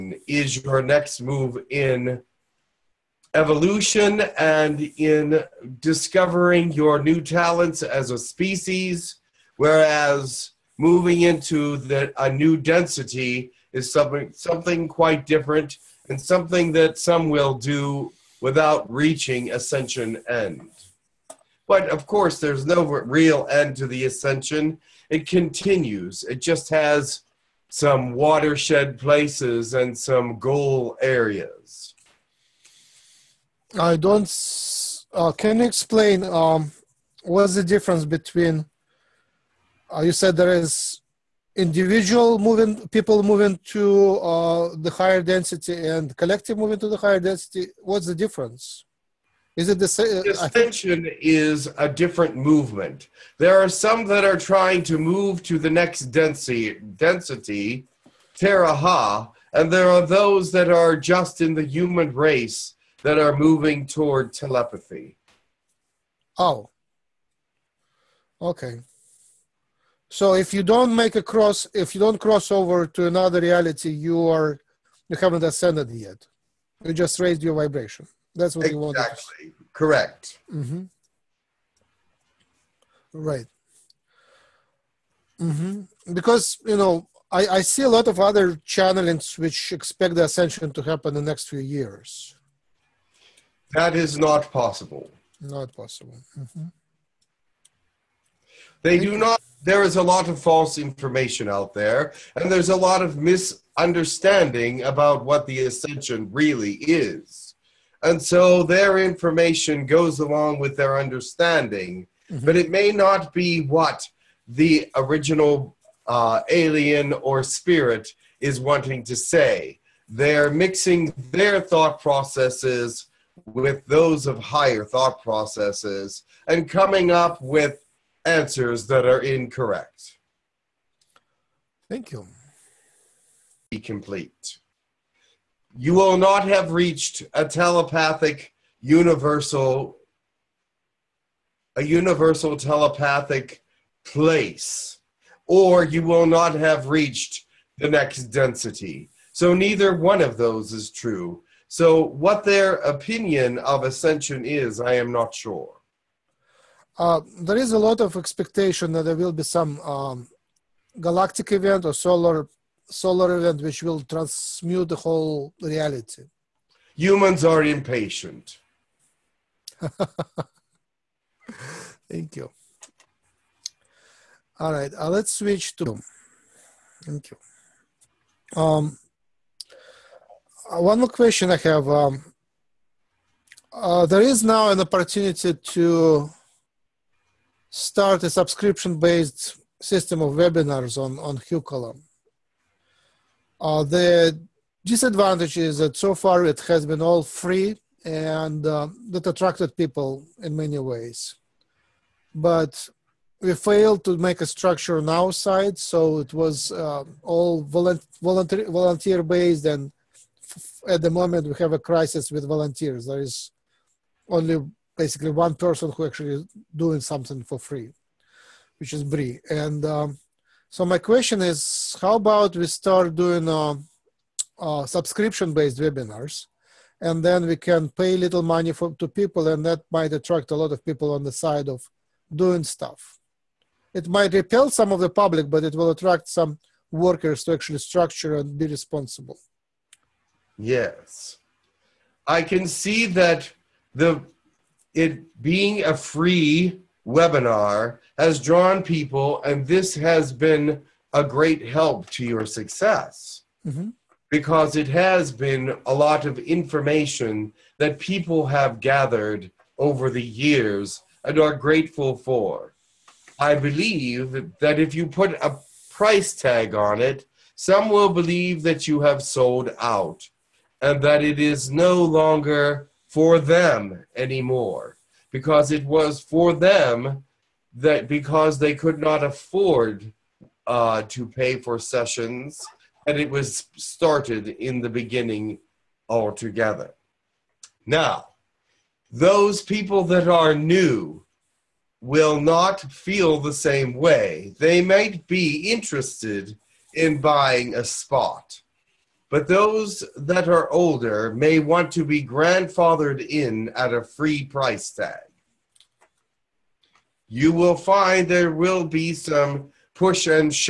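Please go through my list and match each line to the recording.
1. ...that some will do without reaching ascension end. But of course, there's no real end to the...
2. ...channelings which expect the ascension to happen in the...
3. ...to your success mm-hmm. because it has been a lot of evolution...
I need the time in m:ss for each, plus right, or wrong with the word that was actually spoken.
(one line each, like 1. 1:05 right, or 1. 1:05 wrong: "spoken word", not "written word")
1. 0:16 right
2. 1:28 right
3. 4:12 wrong: "information", not "evolution".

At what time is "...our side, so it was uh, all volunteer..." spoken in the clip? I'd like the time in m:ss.
3:25.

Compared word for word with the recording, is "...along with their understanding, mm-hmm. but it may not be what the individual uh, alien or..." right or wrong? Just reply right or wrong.
wrong.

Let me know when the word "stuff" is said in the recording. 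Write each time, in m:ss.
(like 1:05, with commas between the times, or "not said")
3:52.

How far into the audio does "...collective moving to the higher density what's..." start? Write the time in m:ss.
0:46.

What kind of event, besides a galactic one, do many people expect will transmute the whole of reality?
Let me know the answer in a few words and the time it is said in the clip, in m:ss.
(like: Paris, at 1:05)
Solar event, at 2:42.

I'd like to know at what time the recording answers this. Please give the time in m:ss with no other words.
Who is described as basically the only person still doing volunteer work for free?
3:39.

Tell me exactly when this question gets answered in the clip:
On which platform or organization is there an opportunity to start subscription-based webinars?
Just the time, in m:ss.
3:11.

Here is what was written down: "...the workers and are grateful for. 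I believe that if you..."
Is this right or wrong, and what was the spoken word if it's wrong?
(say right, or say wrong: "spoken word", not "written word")
wrong: "years", not "workers".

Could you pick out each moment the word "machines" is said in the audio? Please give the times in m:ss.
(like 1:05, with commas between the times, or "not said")
not said.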